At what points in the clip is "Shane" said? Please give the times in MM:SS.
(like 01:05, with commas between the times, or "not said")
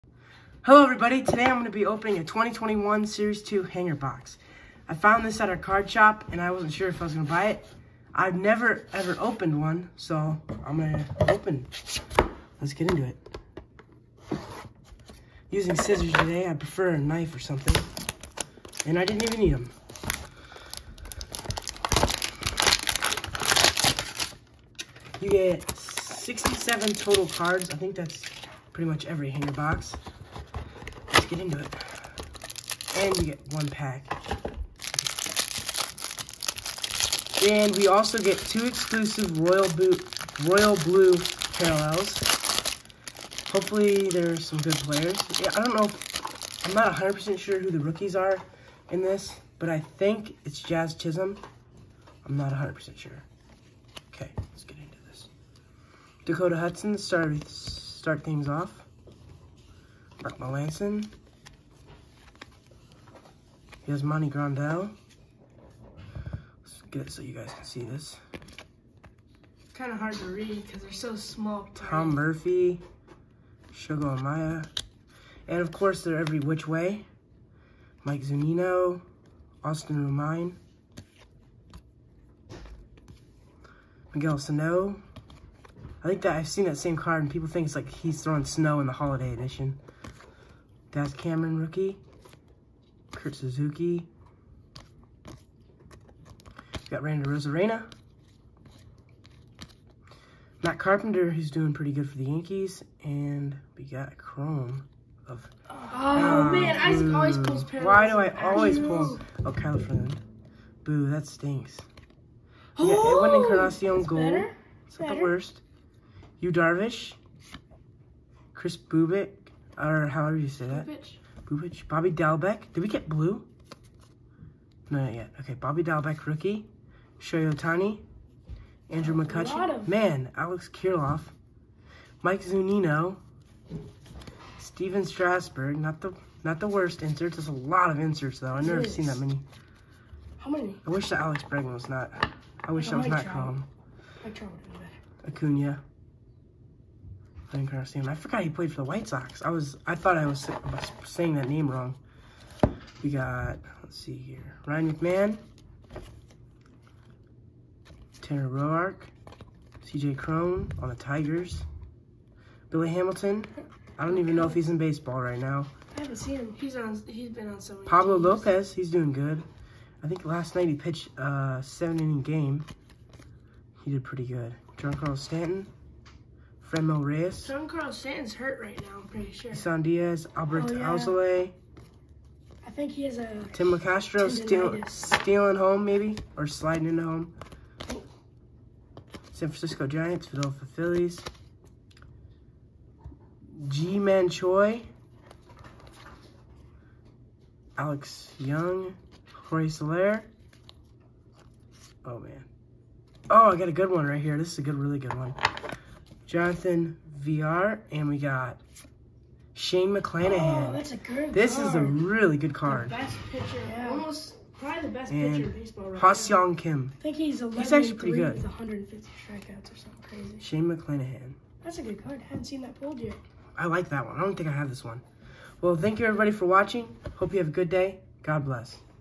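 03:29, 03:40.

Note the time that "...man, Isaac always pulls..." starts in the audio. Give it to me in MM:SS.
01:46.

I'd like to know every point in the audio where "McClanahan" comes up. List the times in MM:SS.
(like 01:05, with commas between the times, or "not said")
03:29, 03:40.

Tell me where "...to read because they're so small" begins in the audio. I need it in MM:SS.
01:10.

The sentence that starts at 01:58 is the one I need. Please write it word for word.
Kris Bubic, or however you say that.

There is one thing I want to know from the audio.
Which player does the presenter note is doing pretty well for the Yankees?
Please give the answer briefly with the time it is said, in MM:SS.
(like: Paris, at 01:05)
Matt Carpenter, at 01:40.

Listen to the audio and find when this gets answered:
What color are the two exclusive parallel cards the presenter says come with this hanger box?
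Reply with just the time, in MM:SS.
00:40.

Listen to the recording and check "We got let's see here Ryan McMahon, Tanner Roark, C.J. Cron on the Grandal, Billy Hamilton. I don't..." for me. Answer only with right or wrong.
wrong.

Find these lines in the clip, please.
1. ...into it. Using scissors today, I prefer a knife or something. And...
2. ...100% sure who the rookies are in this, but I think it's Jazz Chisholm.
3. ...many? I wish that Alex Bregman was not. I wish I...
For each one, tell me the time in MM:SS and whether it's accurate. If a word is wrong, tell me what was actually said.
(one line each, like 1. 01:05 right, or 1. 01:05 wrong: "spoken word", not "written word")
1. 00:12 right
2. 00:46 right
3. 02:20 right.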